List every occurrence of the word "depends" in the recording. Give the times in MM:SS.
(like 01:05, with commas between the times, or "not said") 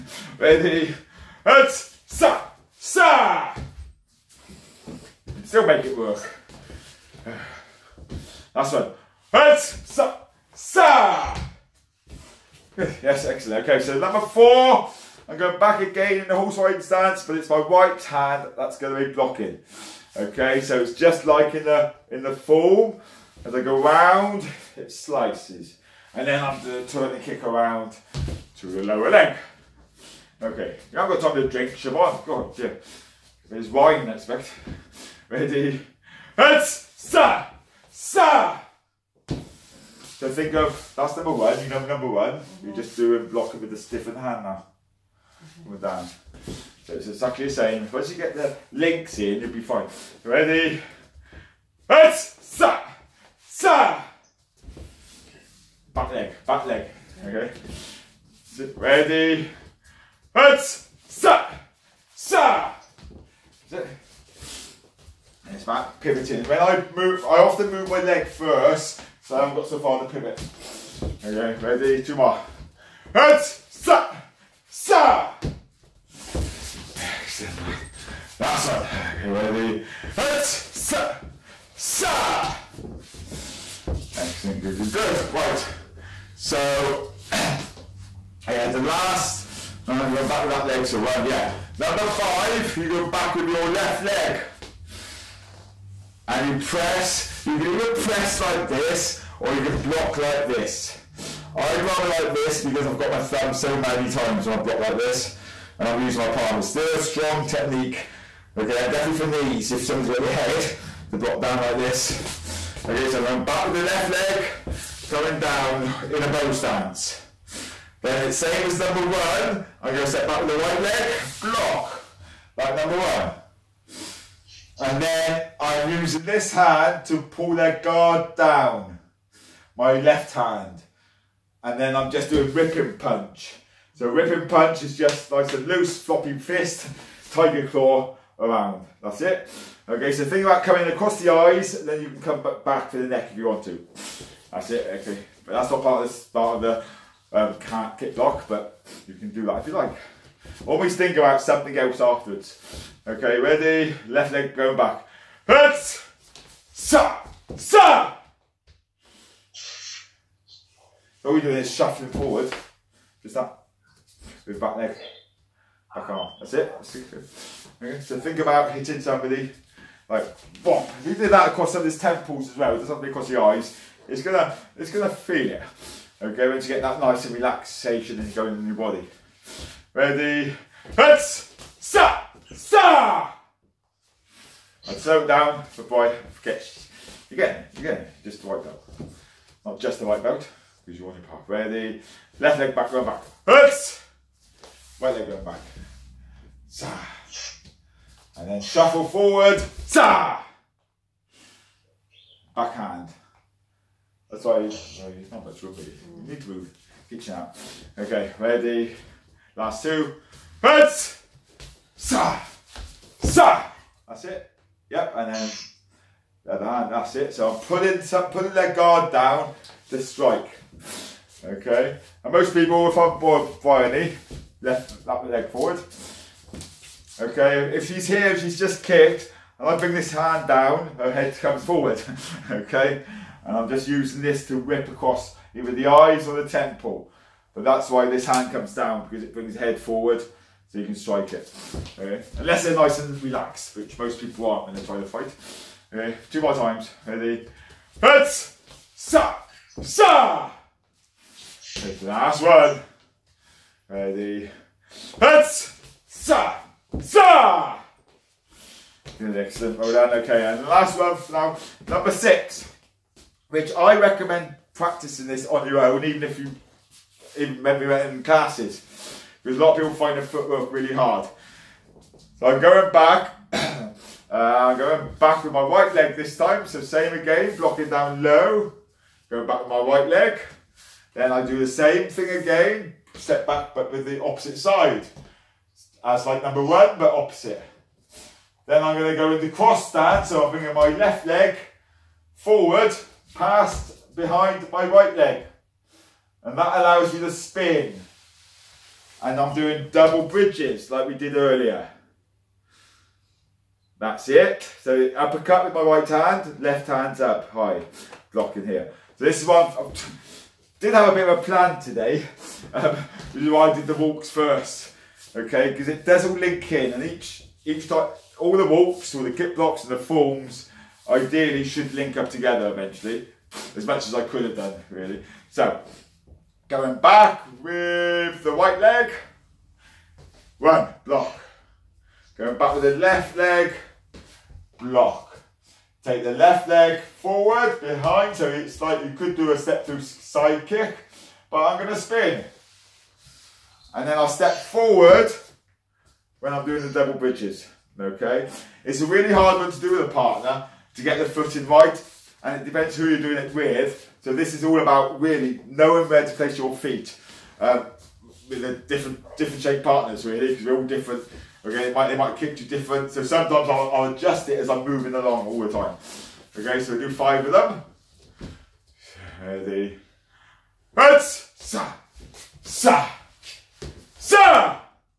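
05:52.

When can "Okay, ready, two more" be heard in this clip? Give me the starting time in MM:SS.
01:11.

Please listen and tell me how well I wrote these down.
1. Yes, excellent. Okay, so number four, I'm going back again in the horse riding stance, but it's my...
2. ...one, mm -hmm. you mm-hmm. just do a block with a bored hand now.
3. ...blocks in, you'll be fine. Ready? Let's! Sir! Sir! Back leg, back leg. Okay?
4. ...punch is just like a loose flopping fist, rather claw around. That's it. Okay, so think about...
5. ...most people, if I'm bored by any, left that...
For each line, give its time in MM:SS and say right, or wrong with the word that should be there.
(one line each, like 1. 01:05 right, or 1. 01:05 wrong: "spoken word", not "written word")
1. 00:12 right
2. 00:42 wrong: "stiffened", not "bored"
3. 00:48 wrong: "links", not "blocks"
4. 02:14 wrong: "tiger", not "rather"
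5. 03:42 right.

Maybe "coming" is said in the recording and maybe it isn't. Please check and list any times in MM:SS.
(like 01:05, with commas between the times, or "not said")
01:55, 02:20.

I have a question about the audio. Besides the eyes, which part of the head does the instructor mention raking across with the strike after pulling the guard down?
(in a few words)
temple.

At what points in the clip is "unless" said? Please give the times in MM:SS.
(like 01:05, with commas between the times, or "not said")
04:02.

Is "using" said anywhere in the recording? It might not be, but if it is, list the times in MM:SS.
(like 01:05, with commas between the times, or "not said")
01:45, 02:05, 03:53.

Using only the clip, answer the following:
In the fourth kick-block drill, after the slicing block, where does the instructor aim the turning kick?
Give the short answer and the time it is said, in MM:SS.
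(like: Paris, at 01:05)
the lower leg, at 00:28.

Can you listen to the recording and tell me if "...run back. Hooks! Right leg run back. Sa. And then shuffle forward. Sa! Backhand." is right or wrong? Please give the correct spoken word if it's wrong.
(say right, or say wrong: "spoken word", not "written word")
right.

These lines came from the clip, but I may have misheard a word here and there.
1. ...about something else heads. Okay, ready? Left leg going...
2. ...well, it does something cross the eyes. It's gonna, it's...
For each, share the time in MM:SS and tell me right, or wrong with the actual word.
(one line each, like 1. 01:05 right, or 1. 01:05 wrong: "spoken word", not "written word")
1. 02:31 wrong: "afterwards", not "heads"
2. 02:52 wrong: "across", not "cross".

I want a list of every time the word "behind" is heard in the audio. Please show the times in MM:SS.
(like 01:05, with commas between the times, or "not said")
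04:54, 05:37.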